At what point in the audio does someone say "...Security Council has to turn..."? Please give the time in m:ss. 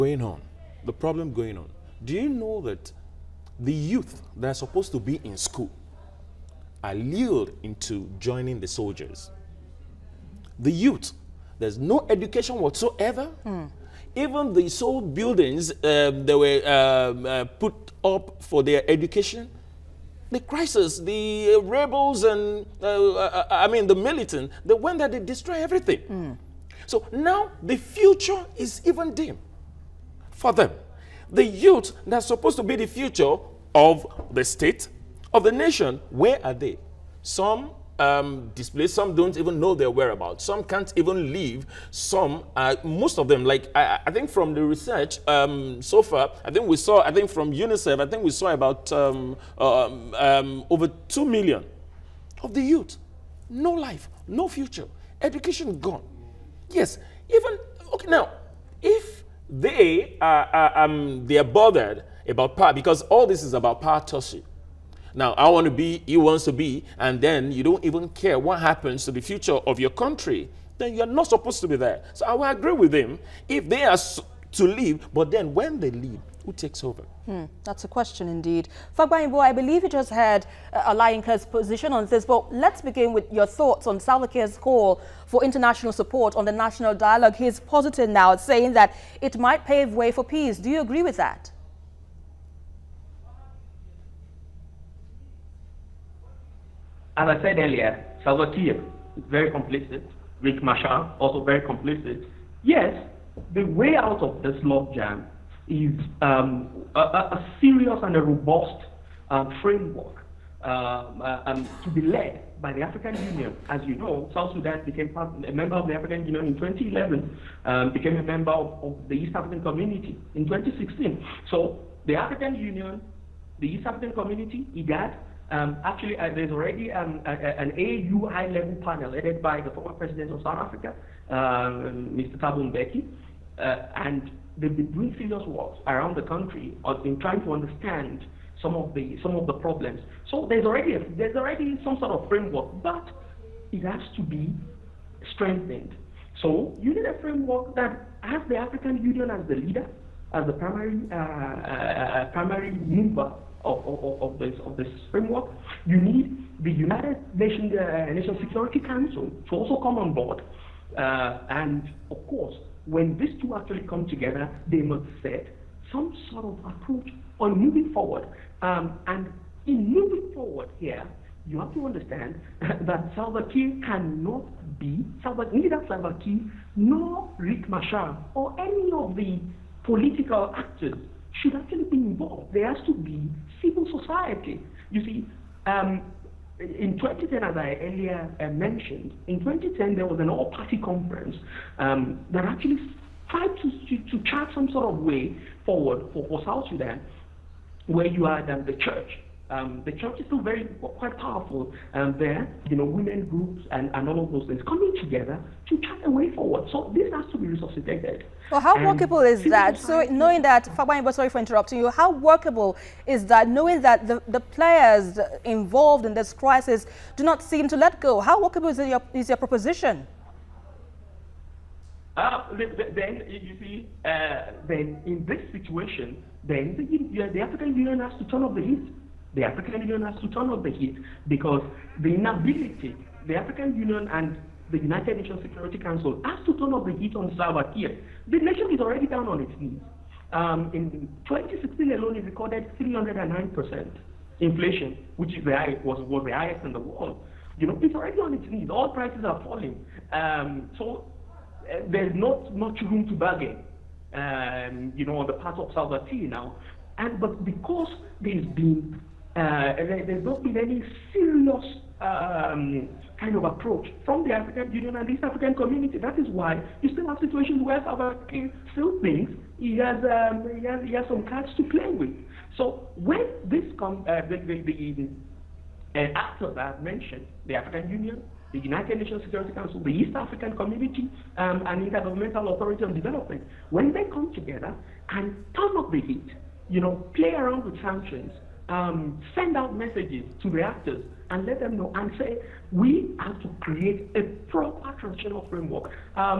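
3:55.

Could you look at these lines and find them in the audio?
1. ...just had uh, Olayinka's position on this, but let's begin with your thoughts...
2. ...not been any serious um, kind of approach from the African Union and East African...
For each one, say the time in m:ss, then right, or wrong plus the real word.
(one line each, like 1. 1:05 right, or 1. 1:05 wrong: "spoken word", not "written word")
1. 1:19 right
2. 4:20 right.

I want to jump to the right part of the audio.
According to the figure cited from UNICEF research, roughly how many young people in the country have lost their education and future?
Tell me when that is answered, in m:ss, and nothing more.
0:50.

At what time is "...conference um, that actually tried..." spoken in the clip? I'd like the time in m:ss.
3:10.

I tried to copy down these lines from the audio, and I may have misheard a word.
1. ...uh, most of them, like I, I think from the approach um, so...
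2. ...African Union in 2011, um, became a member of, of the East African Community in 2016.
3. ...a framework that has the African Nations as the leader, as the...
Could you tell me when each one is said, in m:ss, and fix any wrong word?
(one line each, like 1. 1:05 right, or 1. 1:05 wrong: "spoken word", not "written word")
1. 0:42 wrong: "research", not "approach"
2. 1:55 right
3. 2:27 wrong: "Union", not "Nations".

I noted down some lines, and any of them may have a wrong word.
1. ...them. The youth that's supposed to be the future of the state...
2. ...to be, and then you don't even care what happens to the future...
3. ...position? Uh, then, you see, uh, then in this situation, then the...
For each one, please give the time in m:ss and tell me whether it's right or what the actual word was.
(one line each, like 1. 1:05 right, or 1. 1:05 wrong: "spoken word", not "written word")
1. 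0:30 right
2. 1:06 right
3. 3:39 wrong: "proposition", not "position".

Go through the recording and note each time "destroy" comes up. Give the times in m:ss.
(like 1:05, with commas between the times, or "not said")
0:25.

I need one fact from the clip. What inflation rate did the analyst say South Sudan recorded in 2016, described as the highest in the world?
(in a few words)
309%.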